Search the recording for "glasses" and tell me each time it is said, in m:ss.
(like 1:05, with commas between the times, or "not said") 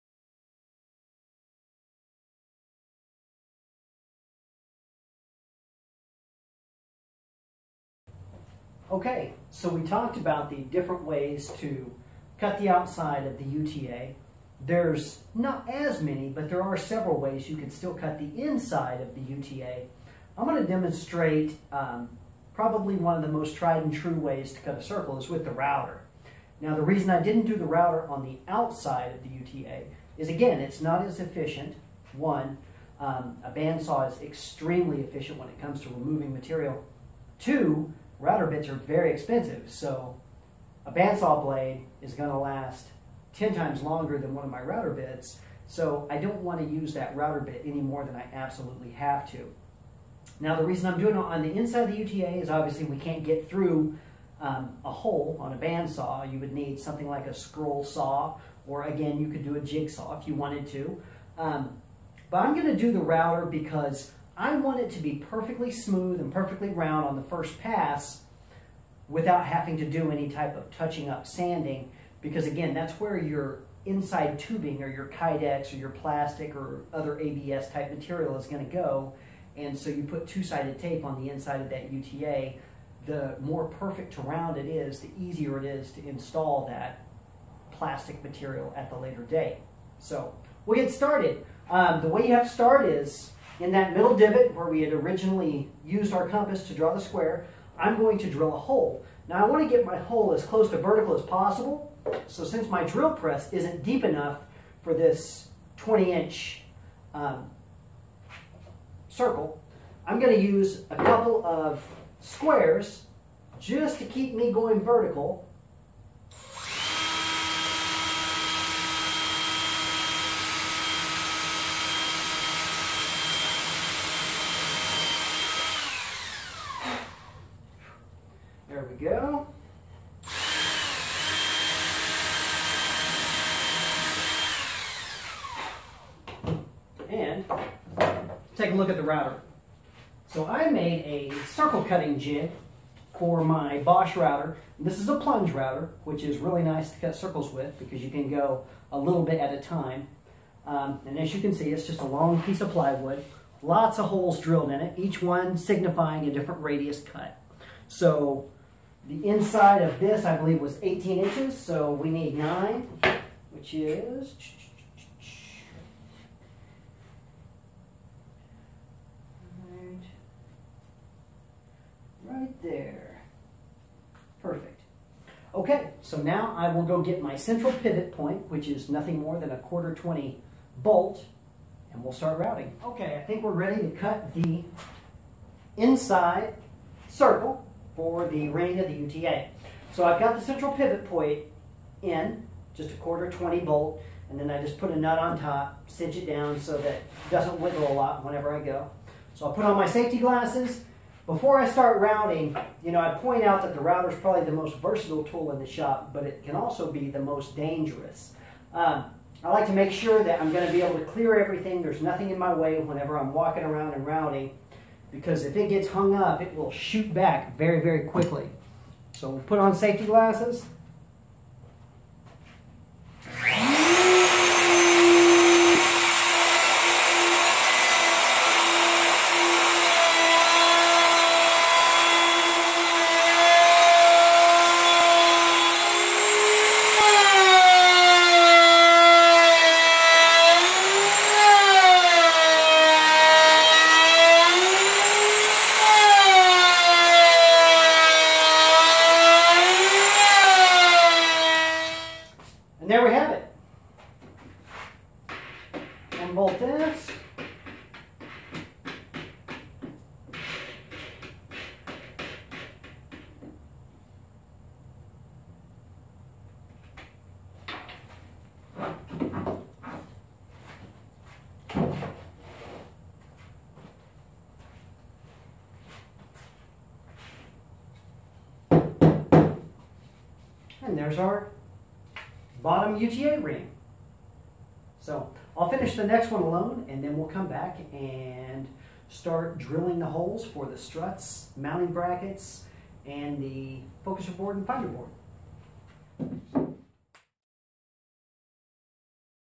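3:20, 3:40.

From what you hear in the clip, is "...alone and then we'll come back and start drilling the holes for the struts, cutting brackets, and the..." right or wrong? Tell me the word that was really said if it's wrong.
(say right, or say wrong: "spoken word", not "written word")
wrong: "mounting", not "cutting".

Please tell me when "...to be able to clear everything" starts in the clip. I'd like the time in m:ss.
3:30.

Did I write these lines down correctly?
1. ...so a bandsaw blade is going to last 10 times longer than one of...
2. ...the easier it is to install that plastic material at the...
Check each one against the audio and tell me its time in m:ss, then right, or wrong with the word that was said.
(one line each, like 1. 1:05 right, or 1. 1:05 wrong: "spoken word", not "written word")
1. 0:39 right
2. 1:25 right.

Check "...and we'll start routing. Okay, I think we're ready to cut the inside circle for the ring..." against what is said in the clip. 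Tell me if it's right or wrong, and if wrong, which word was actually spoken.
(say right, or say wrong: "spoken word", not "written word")
right.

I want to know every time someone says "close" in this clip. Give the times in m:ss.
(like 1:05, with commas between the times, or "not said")
1:40.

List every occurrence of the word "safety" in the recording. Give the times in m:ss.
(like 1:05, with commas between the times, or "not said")
3:19, 3:39.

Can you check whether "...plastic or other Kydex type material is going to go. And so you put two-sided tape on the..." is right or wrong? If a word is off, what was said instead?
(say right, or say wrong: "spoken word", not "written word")
wrong: "ABS", not "Kydex".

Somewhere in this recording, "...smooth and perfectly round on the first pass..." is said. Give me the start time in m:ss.
1:05.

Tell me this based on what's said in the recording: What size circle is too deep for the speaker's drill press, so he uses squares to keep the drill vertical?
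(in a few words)
20 inch.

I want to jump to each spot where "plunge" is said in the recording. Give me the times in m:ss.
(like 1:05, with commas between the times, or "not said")
2:25.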